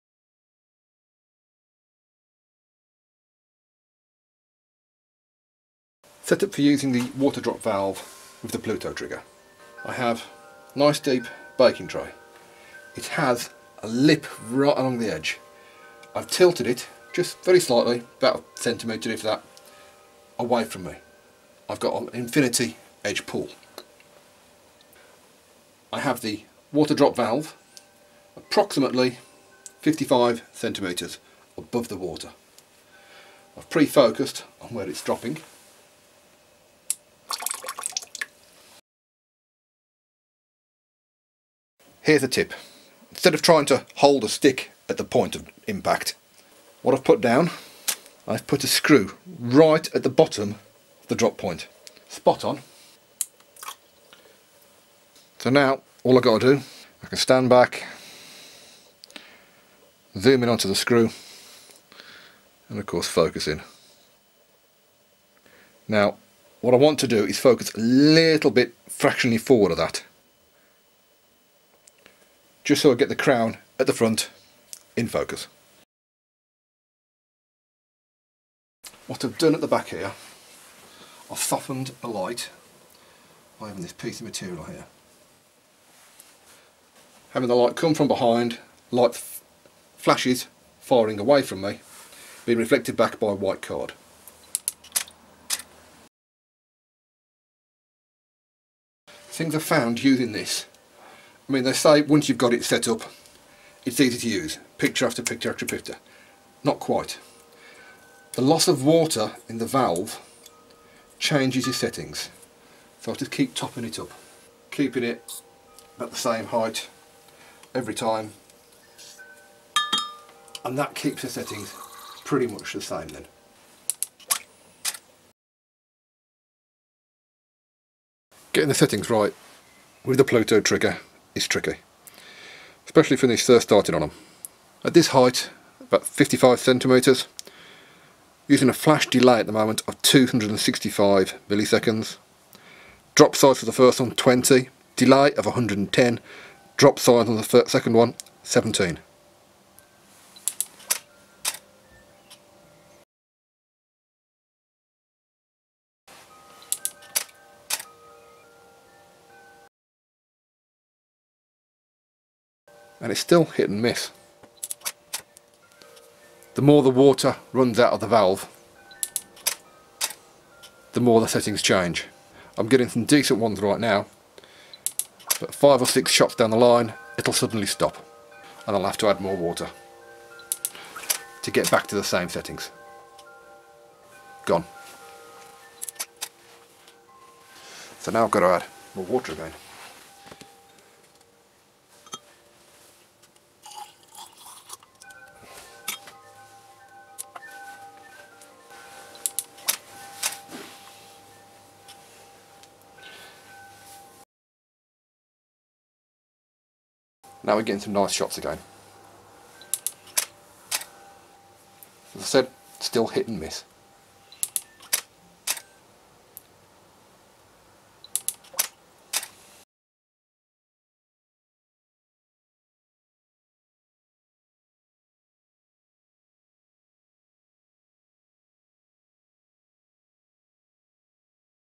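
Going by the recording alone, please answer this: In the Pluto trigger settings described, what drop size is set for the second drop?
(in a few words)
17.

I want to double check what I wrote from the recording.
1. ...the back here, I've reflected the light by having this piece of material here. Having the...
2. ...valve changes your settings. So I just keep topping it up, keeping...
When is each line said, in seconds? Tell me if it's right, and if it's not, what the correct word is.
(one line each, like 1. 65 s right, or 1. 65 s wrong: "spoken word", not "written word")
1. 79 s wrong: "softened", not "reflected"
2. 109 s right.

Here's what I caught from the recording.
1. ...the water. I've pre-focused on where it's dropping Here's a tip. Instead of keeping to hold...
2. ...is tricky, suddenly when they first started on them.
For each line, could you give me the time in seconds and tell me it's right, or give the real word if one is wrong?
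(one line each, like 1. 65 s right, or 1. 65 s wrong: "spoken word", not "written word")
1. 31 s wrong: "trying", not "keeping"
2. 131 s wrong: "especially", not "suddenly".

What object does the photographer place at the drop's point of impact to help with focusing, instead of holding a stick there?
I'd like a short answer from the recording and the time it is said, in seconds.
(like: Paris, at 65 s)
A screw, at 48 s.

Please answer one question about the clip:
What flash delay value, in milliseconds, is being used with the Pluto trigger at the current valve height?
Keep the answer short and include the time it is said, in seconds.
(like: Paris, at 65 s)
265 milliseconds, at 140 s.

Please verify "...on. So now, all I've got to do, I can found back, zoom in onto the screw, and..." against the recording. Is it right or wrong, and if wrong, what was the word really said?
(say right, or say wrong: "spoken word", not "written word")
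wrong: "stand", not "found".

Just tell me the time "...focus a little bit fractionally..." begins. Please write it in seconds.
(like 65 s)
67 s.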